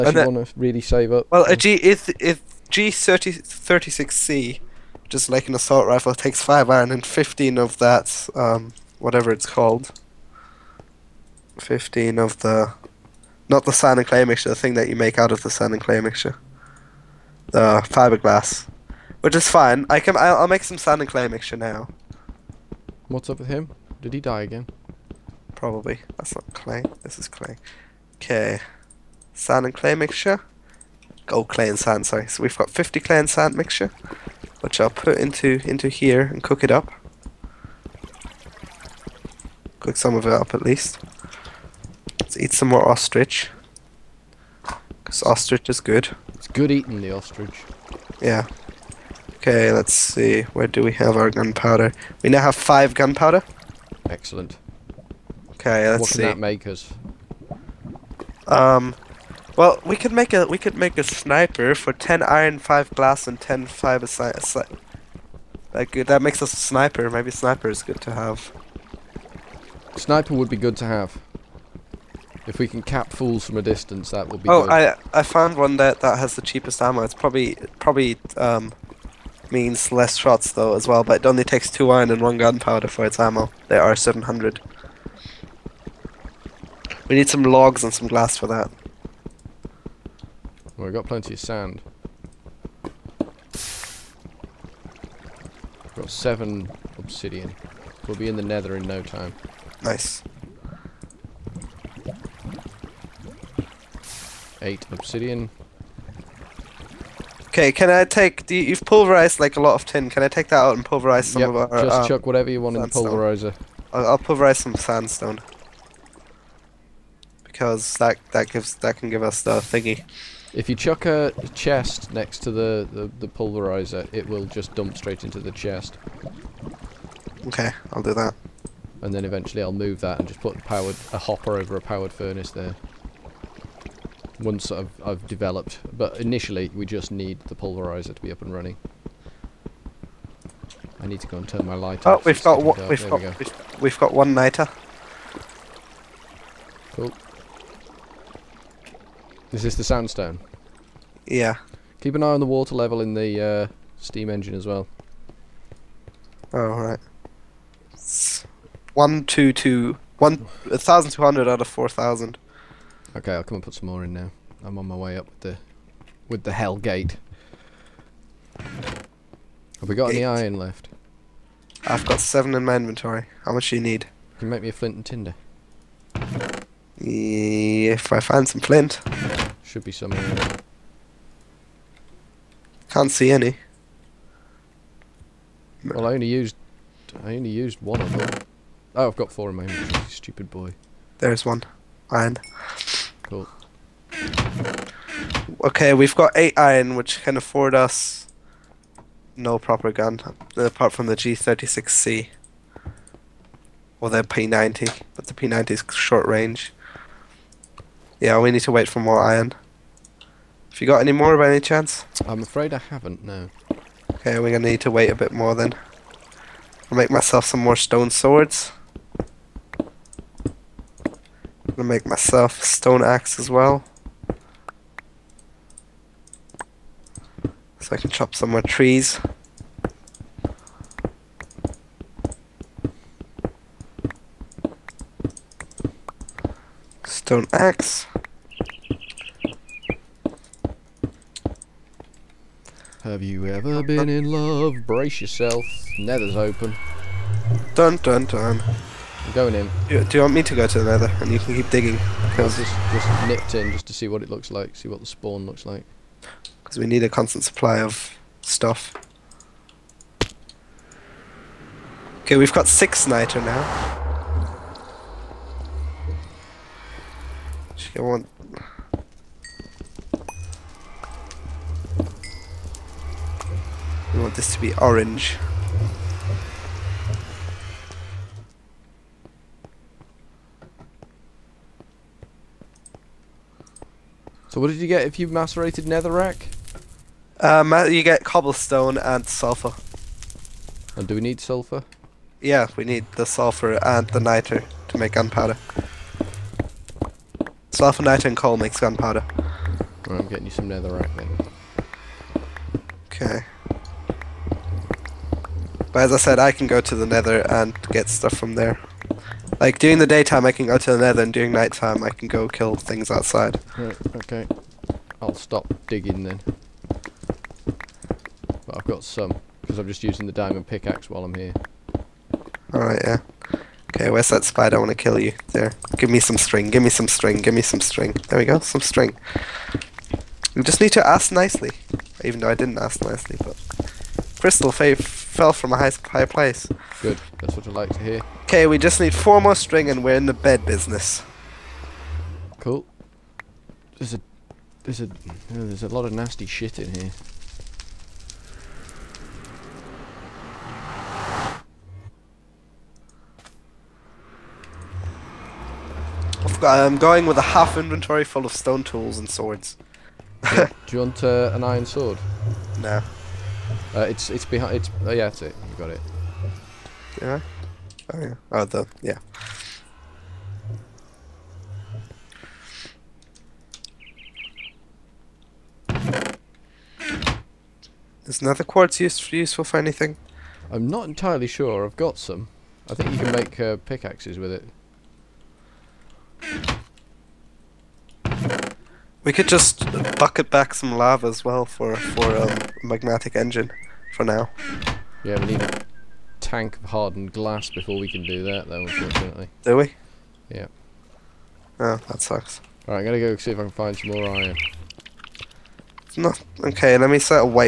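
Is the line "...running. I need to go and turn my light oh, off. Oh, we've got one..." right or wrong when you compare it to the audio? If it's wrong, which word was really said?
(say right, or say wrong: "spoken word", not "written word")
right.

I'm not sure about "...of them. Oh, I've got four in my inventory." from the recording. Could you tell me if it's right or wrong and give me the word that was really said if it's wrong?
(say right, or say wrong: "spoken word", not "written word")
right.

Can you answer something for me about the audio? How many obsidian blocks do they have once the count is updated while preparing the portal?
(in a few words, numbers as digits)
8.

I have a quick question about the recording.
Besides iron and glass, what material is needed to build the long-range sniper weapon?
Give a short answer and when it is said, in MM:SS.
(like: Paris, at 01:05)
fiber, at 01:03.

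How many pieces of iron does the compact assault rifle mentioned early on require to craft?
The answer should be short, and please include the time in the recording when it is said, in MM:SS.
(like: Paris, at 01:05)
5, at 00:06.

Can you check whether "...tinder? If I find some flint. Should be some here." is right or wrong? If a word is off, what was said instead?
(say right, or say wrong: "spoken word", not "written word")
right.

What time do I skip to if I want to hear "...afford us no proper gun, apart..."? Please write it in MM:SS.
03:17.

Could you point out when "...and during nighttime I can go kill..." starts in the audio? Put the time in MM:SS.
05:11.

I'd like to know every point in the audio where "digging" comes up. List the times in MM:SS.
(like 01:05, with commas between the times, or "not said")
04:11, 05:15.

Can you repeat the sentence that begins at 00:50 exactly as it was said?
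Where do we have our gunpowder?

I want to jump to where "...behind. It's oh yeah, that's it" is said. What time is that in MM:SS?
06:04.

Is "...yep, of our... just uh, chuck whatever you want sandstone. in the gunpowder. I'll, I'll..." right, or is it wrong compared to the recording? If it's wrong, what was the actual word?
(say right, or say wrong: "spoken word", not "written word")
wrong: "pulverizer", not "gunpowder".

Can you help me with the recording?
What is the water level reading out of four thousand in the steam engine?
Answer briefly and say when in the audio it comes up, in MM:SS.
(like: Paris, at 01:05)
1,200, at 02:41.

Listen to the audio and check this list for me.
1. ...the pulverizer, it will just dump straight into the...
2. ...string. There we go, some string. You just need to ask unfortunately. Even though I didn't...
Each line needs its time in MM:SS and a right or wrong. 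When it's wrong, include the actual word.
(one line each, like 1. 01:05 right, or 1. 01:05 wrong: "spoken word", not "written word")
1. 02:03 right
2. 05:27 wrong: "nicely", not "unfortunately".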